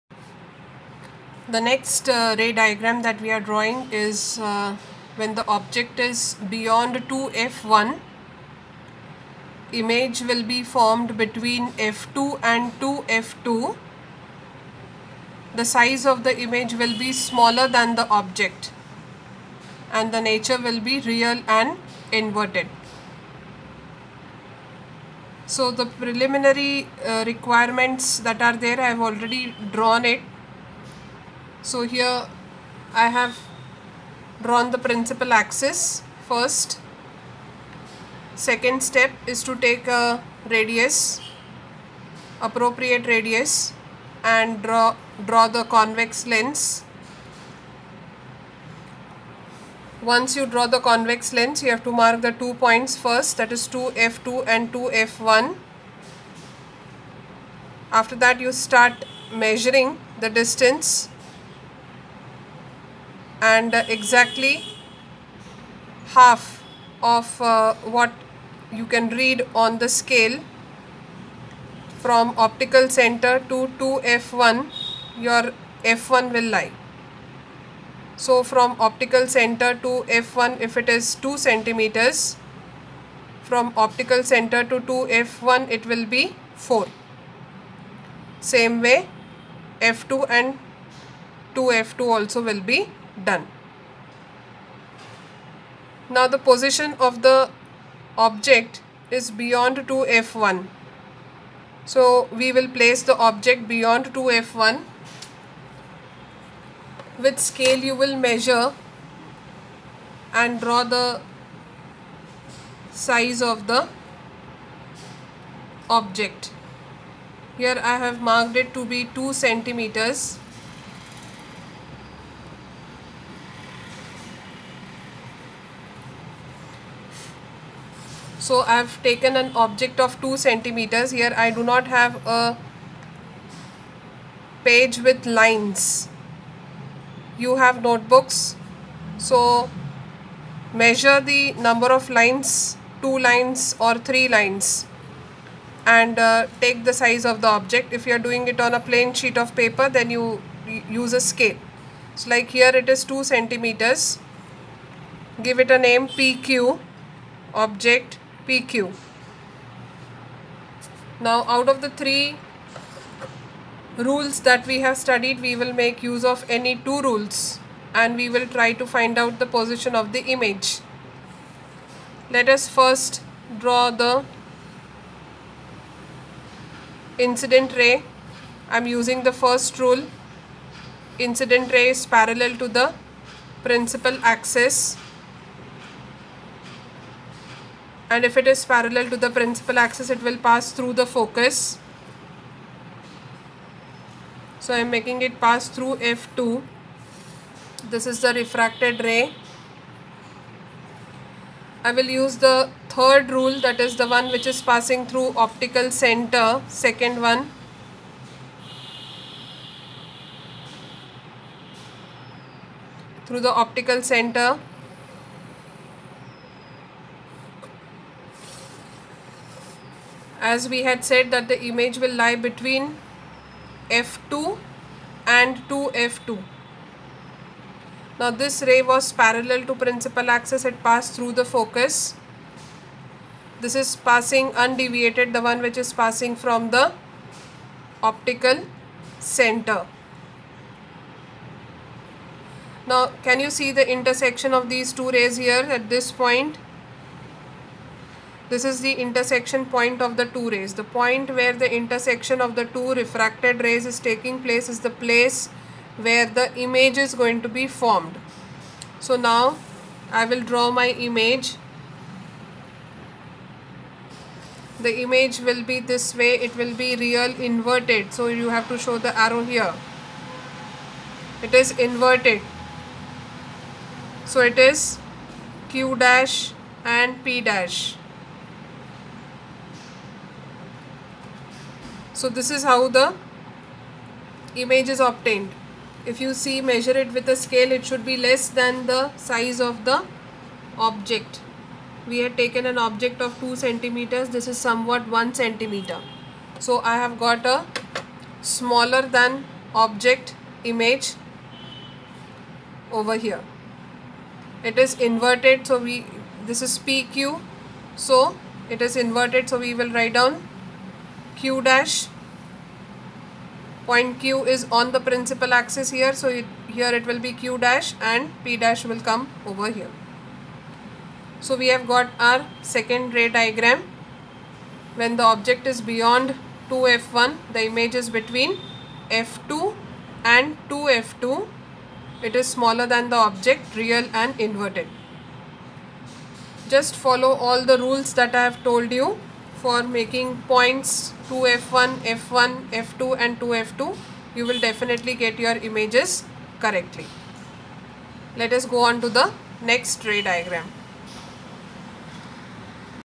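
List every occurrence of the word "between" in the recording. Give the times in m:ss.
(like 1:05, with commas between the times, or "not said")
0:11, 3:42, 5:28.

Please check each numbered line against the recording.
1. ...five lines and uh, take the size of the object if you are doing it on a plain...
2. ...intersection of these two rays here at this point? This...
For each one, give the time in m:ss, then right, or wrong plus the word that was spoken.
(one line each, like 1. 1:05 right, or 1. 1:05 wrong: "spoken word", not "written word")
1. 2:23 wrong: "three", not "five"
2. 4:03 right.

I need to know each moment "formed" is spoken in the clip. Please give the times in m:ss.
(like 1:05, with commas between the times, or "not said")
0:10, 4:17.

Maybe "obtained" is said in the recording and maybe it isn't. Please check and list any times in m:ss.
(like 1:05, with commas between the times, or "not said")
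4:44.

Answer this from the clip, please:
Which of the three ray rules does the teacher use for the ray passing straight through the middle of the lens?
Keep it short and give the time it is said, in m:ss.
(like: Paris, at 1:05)
third rule, at 3:22.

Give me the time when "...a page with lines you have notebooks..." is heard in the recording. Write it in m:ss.
2:12.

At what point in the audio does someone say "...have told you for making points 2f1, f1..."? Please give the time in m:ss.
5:38.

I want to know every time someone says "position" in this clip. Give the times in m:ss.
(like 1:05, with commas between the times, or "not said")
1:36, 2:49.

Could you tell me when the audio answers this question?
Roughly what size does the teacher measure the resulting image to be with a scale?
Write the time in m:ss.
4:55.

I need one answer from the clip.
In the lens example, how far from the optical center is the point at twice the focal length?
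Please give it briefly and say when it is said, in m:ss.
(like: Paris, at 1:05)
4, at 1:26.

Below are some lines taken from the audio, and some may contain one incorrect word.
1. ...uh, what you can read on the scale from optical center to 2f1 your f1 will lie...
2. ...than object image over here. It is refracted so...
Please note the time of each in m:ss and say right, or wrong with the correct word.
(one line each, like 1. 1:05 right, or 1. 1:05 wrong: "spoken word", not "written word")
1. 1:07 right
2. 4:59 wrong: "inverted", not "refracted".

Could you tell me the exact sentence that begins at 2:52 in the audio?
Let us first draw the incident ray.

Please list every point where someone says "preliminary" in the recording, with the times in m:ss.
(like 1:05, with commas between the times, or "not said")
0:25.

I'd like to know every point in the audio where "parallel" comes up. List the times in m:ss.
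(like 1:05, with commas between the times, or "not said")
3:02, 3:08, 3:49.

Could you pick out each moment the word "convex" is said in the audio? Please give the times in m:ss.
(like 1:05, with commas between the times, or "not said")
0:45, 0:50.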